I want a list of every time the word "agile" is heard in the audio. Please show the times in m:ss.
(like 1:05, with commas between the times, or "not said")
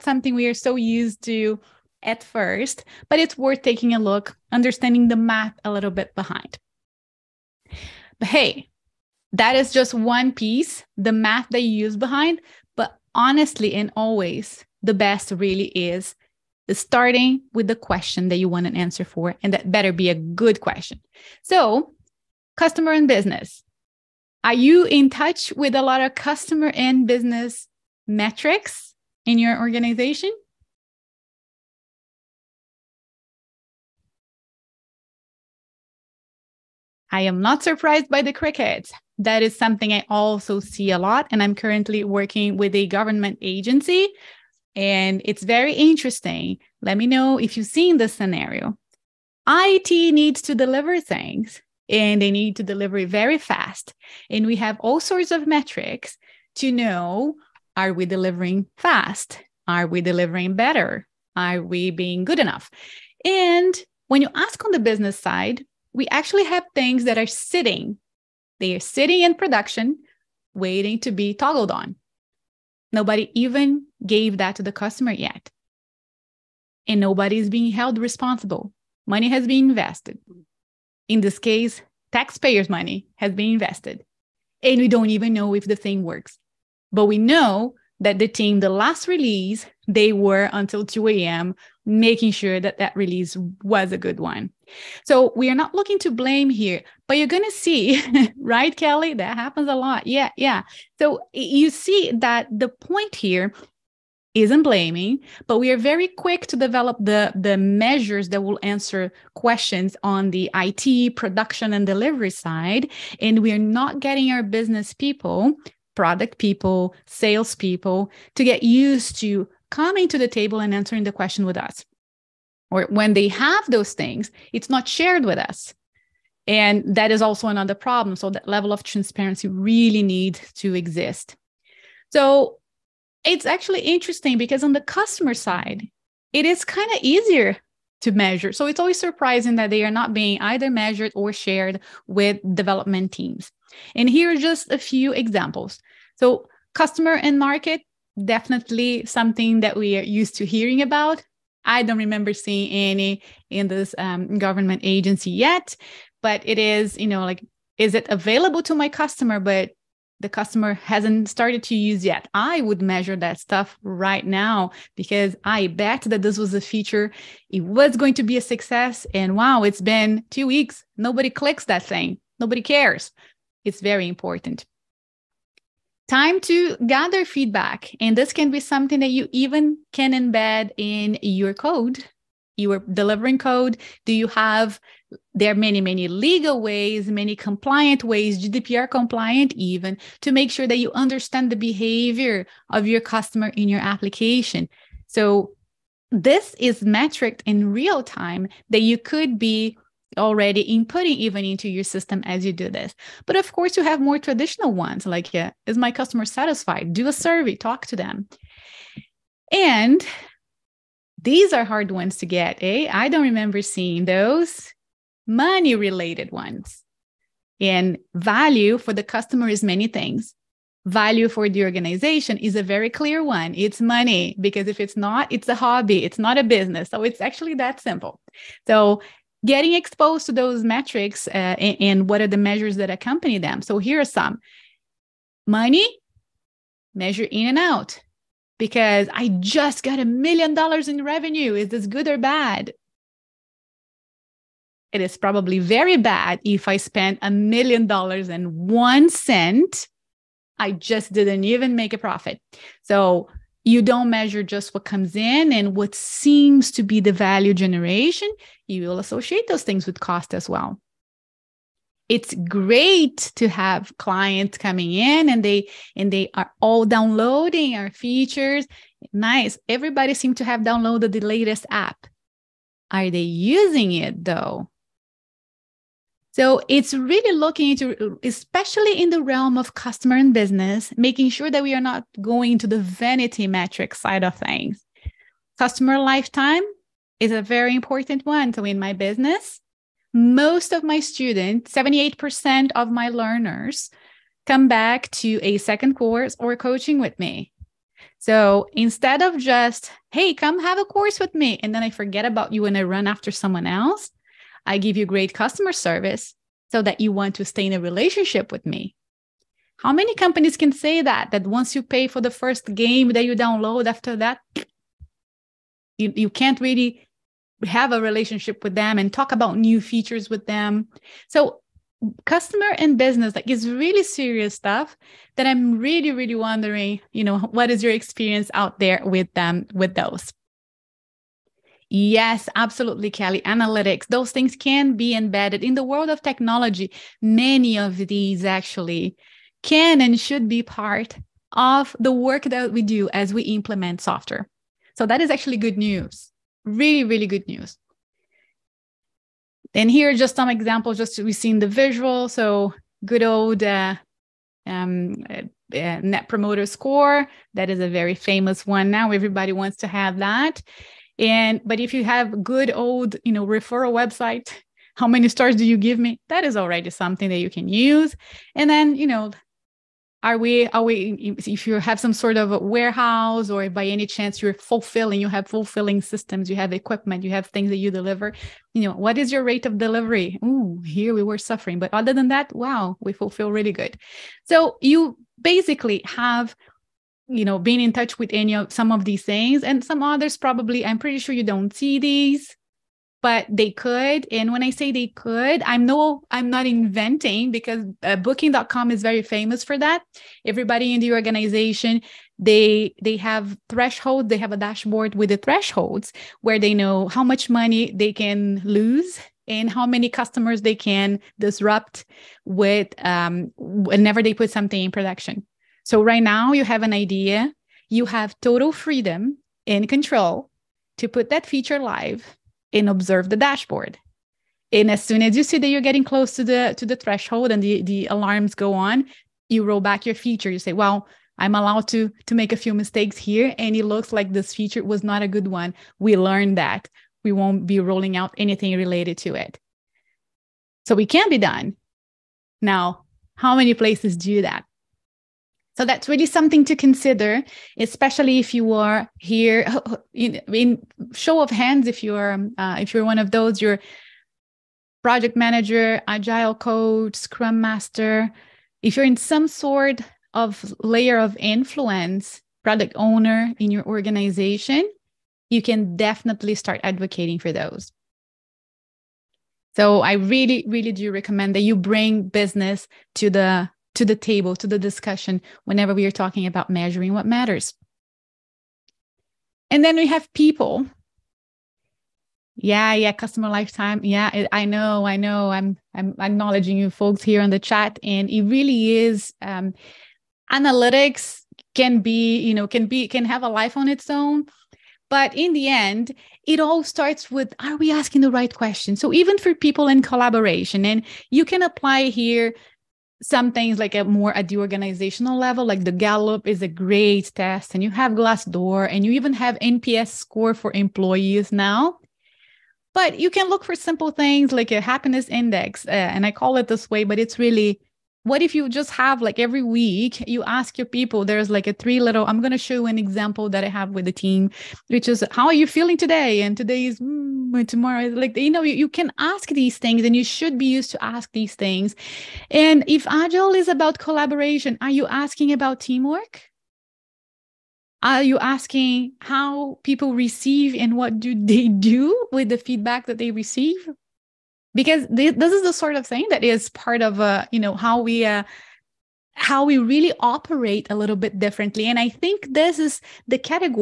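7:36, 8:53.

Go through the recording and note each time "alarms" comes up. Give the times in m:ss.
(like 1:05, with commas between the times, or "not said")
7:08.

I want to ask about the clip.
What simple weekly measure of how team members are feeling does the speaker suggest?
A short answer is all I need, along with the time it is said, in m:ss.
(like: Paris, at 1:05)
Happiness index, at 8:34.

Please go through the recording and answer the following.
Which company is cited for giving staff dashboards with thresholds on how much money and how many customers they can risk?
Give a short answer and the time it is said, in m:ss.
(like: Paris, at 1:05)
Booking.com, at 6:38.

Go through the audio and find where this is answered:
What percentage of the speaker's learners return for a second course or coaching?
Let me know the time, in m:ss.
4:51.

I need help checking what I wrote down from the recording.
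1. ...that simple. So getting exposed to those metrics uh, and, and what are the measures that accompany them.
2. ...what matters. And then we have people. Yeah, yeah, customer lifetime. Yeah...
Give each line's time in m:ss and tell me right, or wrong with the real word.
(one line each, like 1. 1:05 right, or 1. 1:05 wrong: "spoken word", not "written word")
1. 3:47 right
2. 7:57 right.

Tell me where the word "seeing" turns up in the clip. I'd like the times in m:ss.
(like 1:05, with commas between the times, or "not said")
2:32, 3:33.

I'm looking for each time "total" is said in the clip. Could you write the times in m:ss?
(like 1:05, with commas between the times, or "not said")
6:58.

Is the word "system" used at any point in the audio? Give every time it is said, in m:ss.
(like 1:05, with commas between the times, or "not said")
3:21, 6:16.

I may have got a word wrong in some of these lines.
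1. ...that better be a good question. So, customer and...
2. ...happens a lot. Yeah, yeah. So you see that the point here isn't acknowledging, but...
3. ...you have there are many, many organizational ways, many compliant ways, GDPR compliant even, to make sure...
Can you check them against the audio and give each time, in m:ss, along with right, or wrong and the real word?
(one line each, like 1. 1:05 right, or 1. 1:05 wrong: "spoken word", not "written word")
1. 0:19 right
2. 1:39 wrong: "blaming", not "acknowledging"
3. 3:04 wrong: "legal", not "organizational".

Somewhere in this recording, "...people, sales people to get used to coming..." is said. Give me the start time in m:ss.
1:56.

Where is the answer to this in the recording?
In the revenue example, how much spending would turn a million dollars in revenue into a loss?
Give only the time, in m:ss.
4:07.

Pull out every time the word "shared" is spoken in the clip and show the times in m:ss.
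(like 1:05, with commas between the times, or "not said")
2:04, 2:21.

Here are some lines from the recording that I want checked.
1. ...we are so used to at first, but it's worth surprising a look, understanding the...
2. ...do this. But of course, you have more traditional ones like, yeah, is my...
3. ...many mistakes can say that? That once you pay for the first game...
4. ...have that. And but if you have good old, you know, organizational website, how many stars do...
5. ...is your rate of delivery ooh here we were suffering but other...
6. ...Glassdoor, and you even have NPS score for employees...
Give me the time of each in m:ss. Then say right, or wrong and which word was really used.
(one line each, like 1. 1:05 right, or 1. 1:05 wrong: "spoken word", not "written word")
1. 0:00 wrong: "taking", not "surprising"
2. 3:22 right
3. 5:09 wrong: "companies", not "mistakes"
4. 5:59 wrong: "referral", not "organizational"
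5. 6:19 right
6. 8:28 right.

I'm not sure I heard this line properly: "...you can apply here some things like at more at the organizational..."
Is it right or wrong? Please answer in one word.
right.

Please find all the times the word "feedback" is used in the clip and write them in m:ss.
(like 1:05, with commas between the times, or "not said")
2:57, 9:02.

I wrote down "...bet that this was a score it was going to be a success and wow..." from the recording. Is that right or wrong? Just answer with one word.
wrong.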